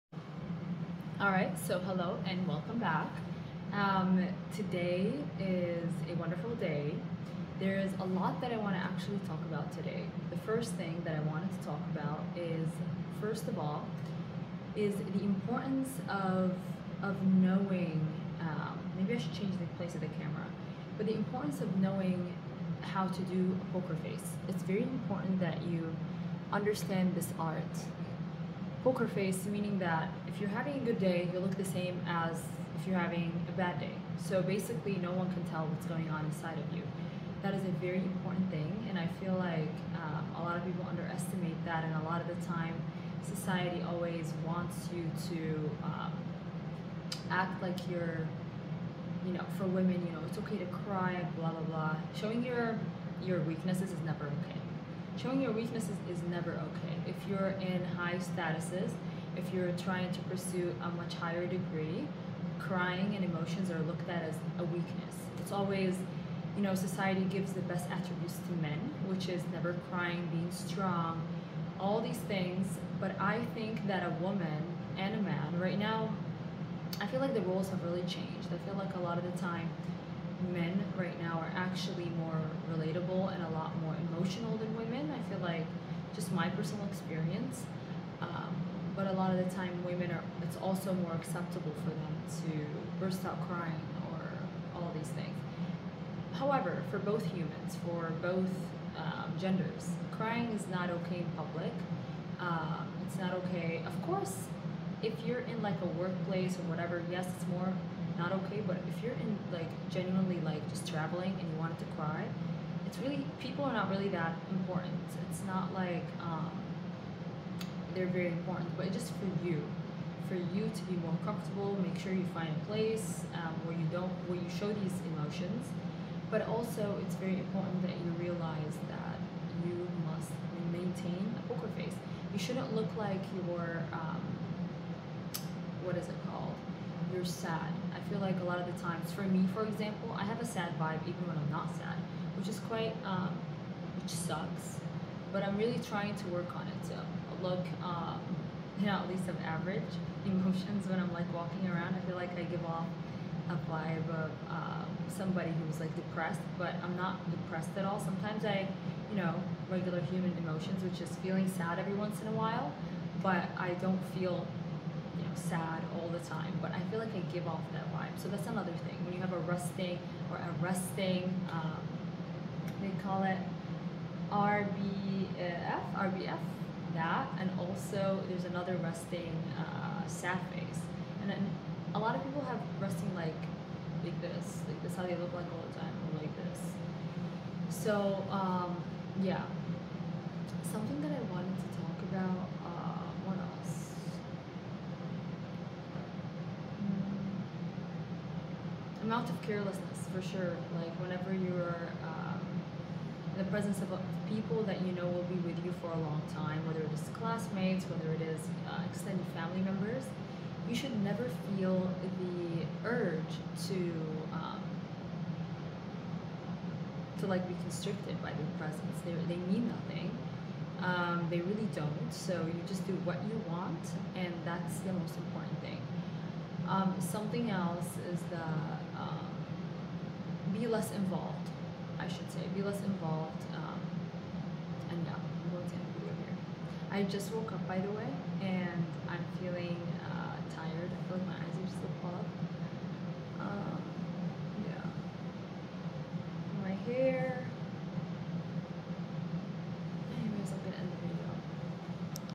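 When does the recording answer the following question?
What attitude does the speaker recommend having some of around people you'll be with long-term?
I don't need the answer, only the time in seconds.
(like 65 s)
199 s.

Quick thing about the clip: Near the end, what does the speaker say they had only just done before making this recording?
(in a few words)
woke up.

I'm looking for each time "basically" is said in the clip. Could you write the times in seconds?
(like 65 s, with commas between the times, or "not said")
34 s.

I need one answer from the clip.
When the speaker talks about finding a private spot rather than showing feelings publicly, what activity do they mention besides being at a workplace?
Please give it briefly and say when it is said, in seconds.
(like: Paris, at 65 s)
traveling, at 110 s.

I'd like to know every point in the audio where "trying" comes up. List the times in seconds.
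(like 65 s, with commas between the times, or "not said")
59 s, 145 s.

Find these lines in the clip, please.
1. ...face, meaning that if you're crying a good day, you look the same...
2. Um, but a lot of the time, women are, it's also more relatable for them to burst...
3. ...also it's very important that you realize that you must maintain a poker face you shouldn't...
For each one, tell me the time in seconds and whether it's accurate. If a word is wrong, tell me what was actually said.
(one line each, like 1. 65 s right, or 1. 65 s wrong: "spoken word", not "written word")
1. 29 s wrong: "having", not "crying"
2. 88 s wrong: "acceptable", not "relatable"
3. 126 s right.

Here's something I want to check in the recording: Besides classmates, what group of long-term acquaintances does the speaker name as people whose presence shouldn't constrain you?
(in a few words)
extended family members.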